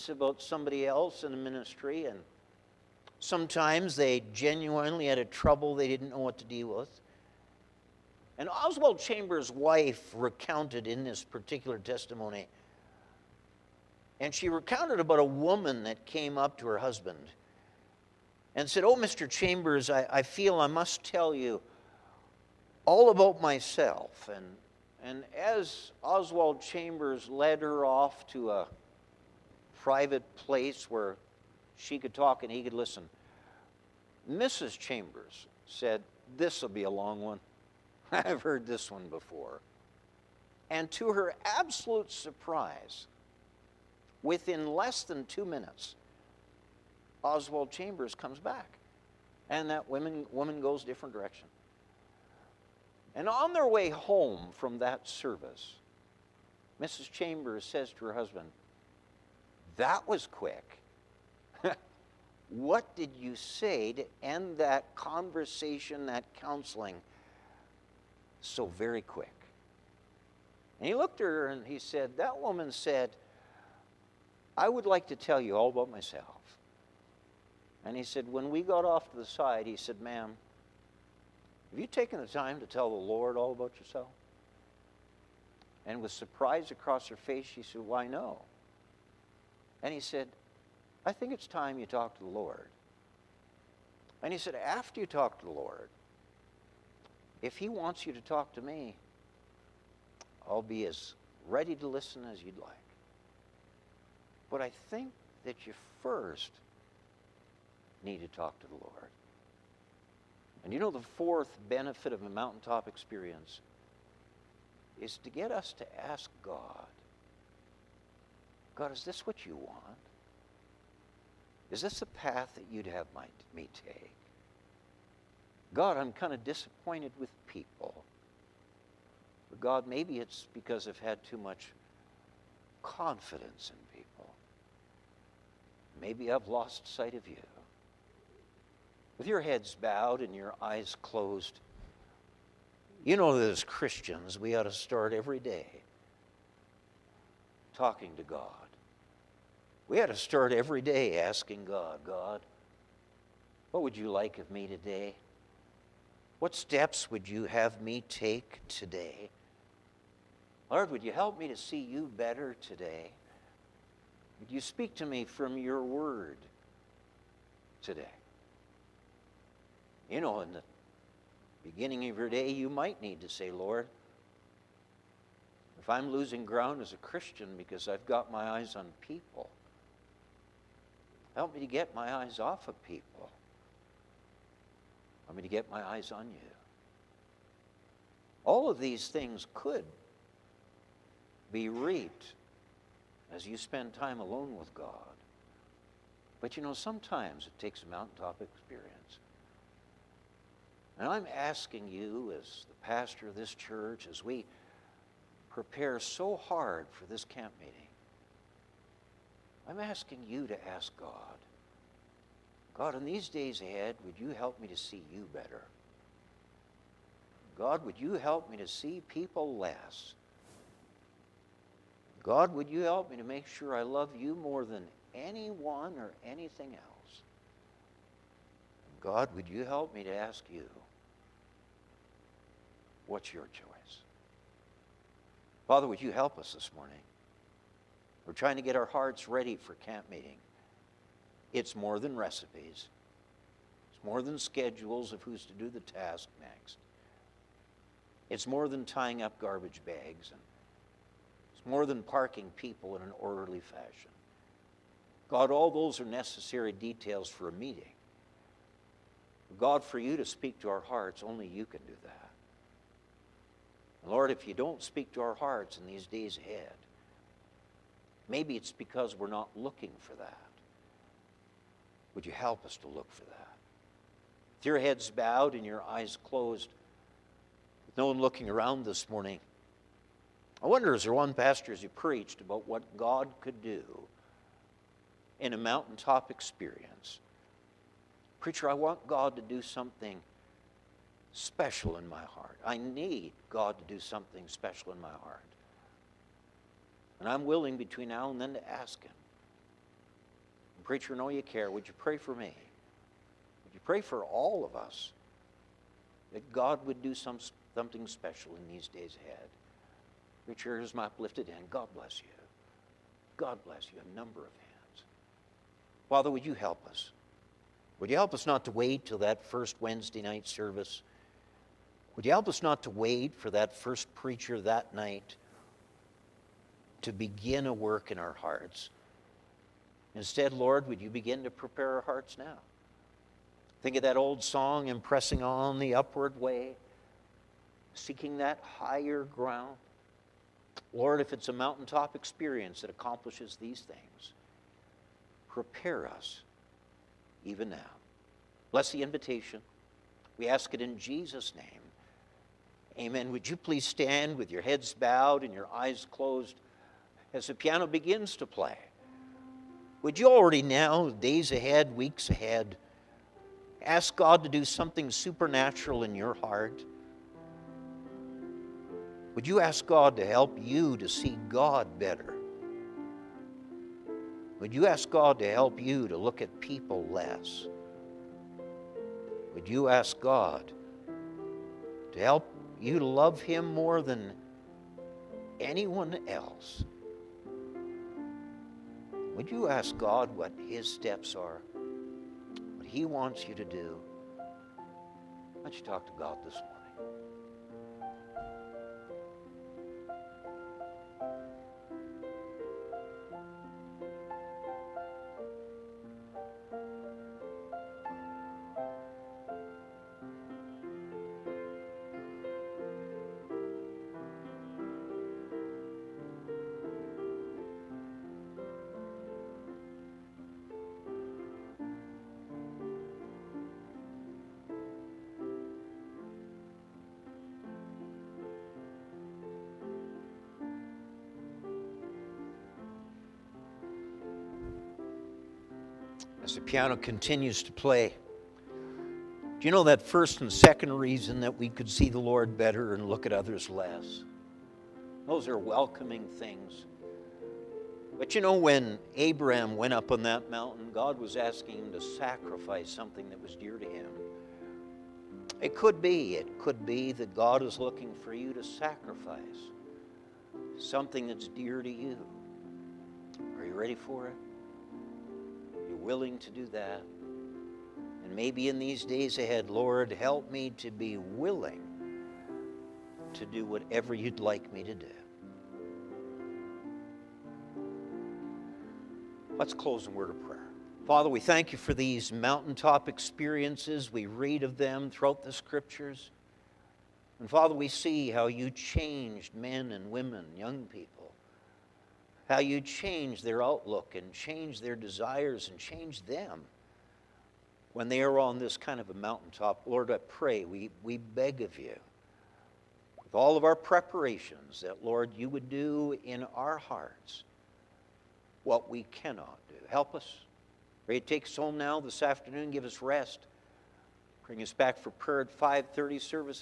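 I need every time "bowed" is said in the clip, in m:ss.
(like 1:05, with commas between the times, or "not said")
2:19, 4:35, 5:54.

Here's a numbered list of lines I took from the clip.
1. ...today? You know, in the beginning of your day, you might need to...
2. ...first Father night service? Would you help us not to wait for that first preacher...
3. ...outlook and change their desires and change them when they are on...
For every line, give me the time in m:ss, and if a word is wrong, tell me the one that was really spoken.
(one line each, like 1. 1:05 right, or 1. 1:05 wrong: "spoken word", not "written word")
1. 2:47 right
2. 5:19 wrong: "Wednesday", not "Father"
3. 8:13 right.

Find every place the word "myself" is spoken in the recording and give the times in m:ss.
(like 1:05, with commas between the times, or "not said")
0:23, 1:15.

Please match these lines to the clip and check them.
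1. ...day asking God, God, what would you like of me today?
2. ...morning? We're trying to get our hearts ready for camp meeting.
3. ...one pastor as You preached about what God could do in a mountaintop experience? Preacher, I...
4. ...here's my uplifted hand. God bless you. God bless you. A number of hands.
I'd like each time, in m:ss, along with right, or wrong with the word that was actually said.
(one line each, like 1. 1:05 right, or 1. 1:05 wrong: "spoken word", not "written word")
1. 2:30 right
2. 3:56 right
3. 4:41 right
4. 5:10 right.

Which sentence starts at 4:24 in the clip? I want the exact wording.
Lord, if you don't speak to our hearts in these days ahead, maybe it's because we're not looking for that.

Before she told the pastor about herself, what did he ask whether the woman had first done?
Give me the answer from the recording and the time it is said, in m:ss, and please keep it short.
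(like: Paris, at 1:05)
Tell the Lord all about yourself, at 1:22.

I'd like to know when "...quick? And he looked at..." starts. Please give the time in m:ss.
1:09.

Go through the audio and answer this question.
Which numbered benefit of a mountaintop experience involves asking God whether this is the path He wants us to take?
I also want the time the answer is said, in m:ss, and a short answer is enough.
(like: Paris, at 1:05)
Fourth, at 1:51.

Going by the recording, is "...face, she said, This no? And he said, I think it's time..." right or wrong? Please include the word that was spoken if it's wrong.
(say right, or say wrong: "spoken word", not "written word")
wrong: "Why", not "This".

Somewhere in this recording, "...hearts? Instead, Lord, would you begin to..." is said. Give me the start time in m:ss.
5:28.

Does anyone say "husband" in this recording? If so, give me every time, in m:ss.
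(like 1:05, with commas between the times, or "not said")
0:16, 0:58.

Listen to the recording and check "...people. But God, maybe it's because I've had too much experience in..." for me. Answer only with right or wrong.
wrong.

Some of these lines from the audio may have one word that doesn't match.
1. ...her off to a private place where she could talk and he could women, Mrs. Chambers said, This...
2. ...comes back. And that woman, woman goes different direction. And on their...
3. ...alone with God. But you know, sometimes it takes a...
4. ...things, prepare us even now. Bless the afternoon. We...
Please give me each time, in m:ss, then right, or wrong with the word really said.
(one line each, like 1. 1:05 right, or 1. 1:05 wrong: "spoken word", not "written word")
1. 0:27 wrong: "listen", not "women"
2. 0:48 right
3. 3:14 right
4. 5:43 wrong: "invitation", not "afternoon".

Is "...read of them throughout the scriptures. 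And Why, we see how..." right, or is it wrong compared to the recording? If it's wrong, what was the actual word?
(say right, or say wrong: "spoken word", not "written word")
wrong: "Father", not "Why".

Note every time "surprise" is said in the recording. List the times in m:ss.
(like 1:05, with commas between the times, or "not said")
0:42, 1:26.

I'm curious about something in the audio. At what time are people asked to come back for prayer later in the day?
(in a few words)
5:30.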